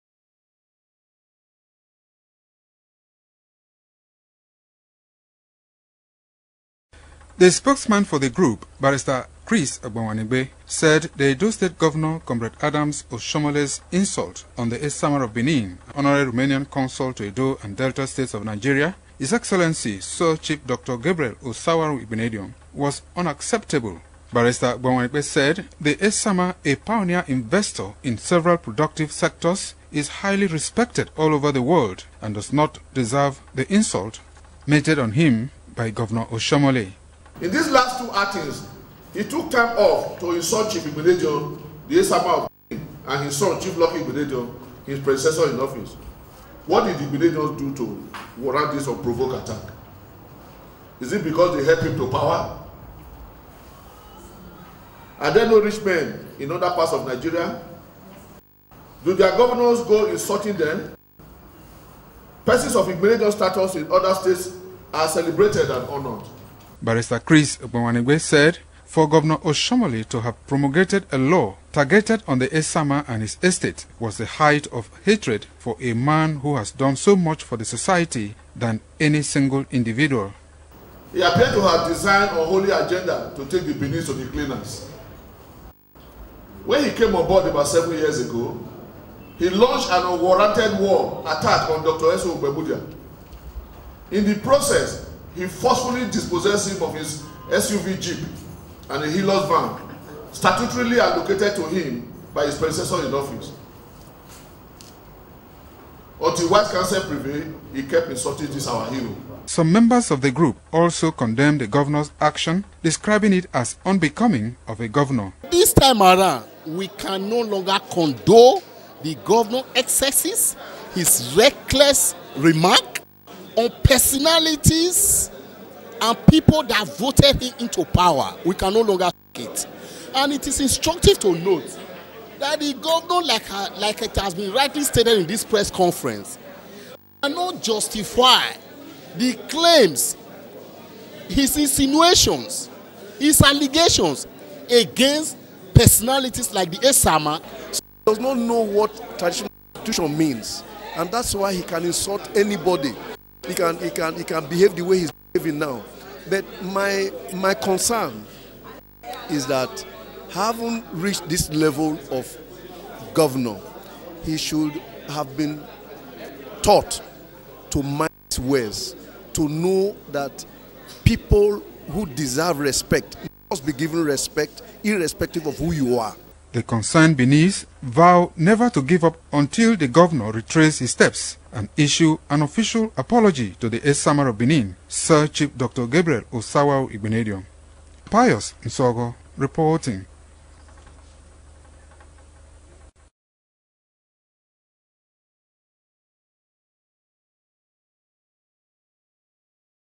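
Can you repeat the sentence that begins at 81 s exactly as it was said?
He appeared to have designed a holy agenda to take the business of the cleaners.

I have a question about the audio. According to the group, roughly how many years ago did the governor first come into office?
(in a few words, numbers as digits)
7.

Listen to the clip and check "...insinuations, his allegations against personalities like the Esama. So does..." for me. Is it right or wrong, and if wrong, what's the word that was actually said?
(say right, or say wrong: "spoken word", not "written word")
right.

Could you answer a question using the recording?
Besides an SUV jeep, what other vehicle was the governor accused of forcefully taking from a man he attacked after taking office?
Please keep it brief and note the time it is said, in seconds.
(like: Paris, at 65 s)
Hilux van, at 99 s.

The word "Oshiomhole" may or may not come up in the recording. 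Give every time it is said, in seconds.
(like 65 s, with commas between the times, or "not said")
13 s, 69 s.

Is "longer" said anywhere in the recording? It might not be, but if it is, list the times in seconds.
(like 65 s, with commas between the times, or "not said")
117 s, 128 s.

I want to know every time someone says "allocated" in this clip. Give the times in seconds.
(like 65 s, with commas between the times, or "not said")
100 s.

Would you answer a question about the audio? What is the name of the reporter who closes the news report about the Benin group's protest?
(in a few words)
Pius Nsogo.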